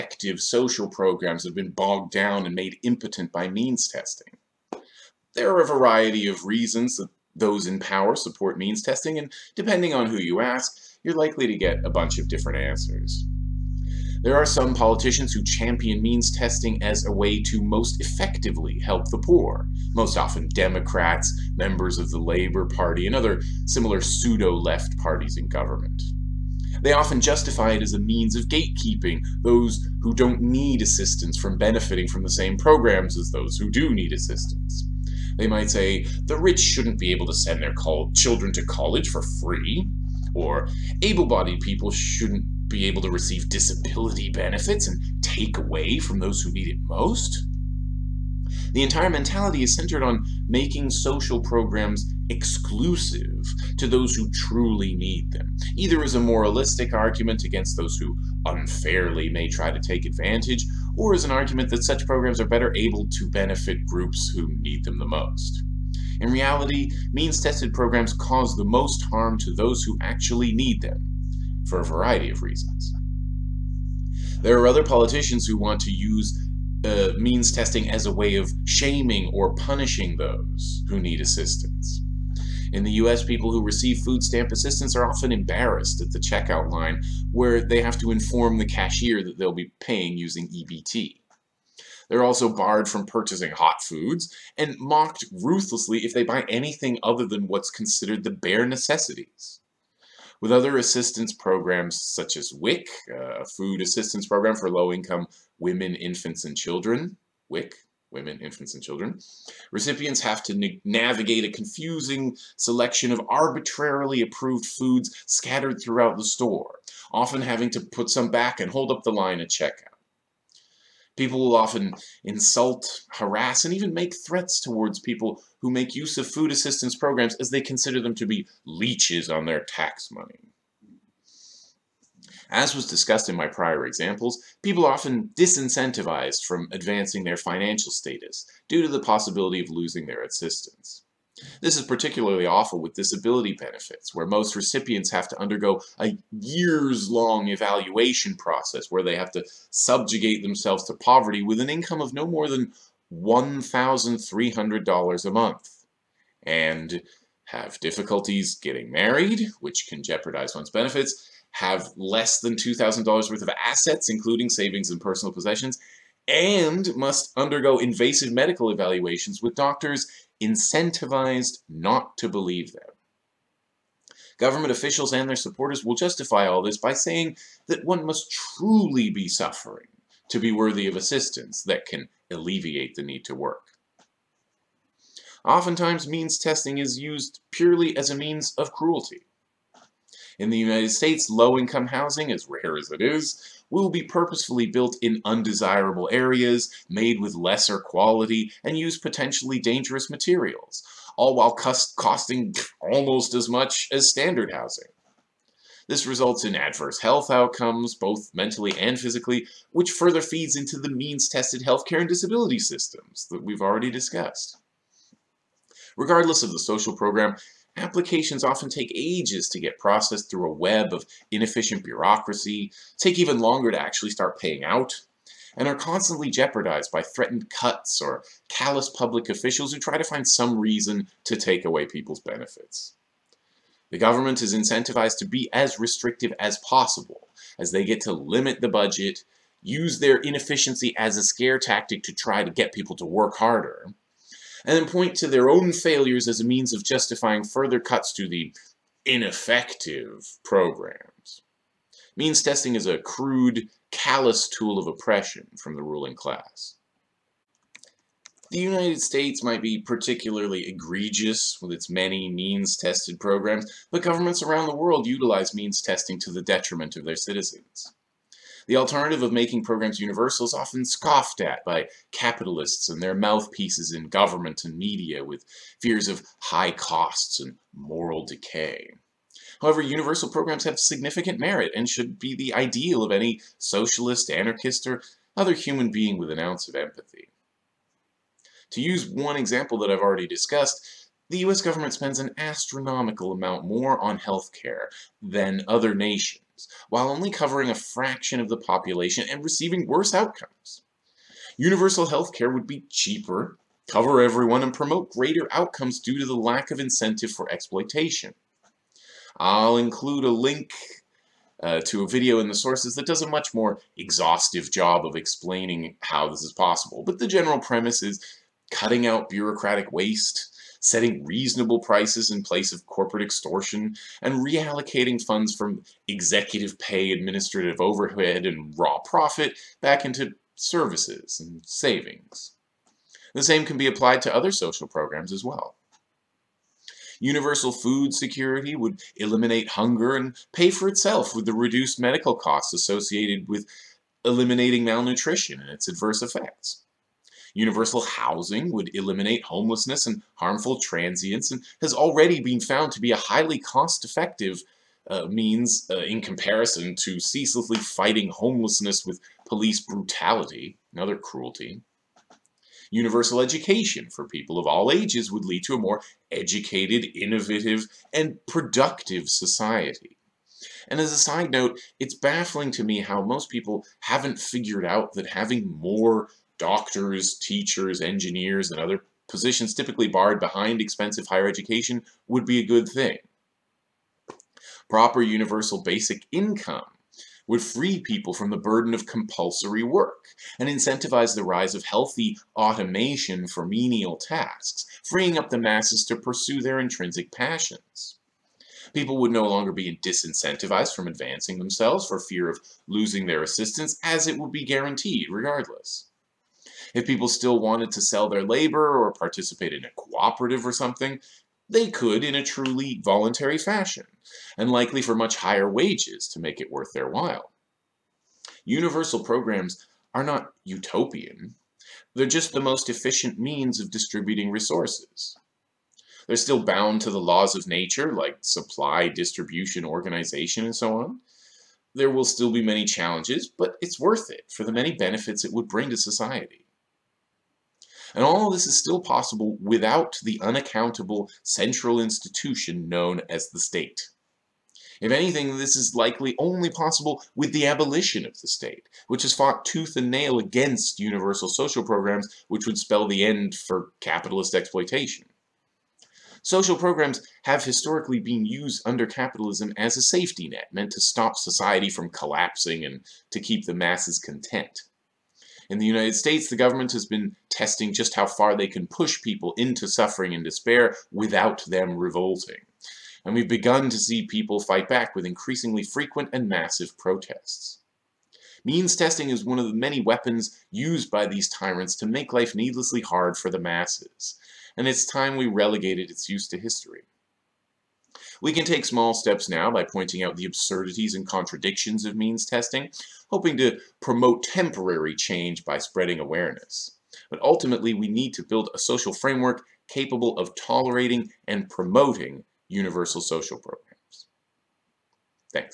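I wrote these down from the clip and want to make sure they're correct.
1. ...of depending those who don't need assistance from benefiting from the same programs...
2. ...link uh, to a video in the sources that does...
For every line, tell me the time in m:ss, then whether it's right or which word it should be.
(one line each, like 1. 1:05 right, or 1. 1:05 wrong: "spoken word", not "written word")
1. 0:28 wrong: "gatekeeping", not "depending"
2. 5:10 right.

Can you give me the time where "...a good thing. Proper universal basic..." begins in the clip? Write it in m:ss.
6:22.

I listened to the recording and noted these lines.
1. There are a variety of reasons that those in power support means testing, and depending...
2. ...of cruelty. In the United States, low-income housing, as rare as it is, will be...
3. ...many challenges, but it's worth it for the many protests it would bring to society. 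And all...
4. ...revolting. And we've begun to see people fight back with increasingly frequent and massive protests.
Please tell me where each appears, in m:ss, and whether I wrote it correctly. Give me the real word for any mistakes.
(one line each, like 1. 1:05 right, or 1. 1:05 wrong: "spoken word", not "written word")
1. 0:05 right
2. 3:08 right
3. 7:12 wrong: "benefits", not "protests"
4. 7:51 right.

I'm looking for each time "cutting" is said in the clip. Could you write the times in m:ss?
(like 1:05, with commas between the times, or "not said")
5:18.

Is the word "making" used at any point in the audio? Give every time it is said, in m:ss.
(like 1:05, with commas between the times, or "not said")
0:50, 4:29.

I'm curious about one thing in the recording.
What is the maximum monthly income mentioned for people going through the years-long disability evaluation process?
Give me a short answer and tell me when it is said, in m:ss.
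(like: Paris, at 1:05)
$1,300, at 2:33.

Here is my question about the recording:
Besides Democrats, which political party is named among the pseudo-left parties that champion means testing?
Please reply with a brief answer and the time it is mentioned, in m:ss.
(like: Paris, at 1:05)
Labour Party, at 0:22.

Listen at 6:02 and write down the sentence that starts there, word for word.
Universal education for people of all ages would lead to a more educated, innovative, and productive society.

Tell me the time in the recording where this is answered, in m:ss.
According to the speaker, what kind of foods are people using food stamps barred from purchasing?
1:33.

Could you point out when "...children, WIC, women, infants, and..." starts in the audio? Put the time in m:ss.
1:46.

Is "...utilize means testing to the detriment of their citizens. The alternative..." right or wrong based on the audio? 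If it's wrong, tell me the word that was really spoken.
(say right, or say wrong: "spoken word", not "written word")
right.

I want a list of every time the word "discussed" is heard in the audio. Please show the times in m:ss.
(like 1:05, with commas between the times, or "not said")
2:12, 3:33, 4:50.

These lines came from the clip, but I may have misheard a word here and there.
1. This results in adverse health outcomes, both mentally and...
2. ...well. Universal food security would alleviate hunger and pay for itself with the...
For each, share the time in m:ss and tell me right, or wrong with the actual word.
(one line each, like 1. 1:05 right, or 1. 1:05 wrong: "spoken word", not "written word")
1. 3:25 right
2. 5:35 wrong: "eliminate", not "alleviate".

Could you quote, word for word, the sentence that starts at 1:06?
In reality, means-tested programs cause the most harm to those who actually need them, for a variety of reasons.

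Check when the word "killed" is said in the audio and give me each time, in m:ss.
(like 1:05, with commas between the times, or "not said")
not said.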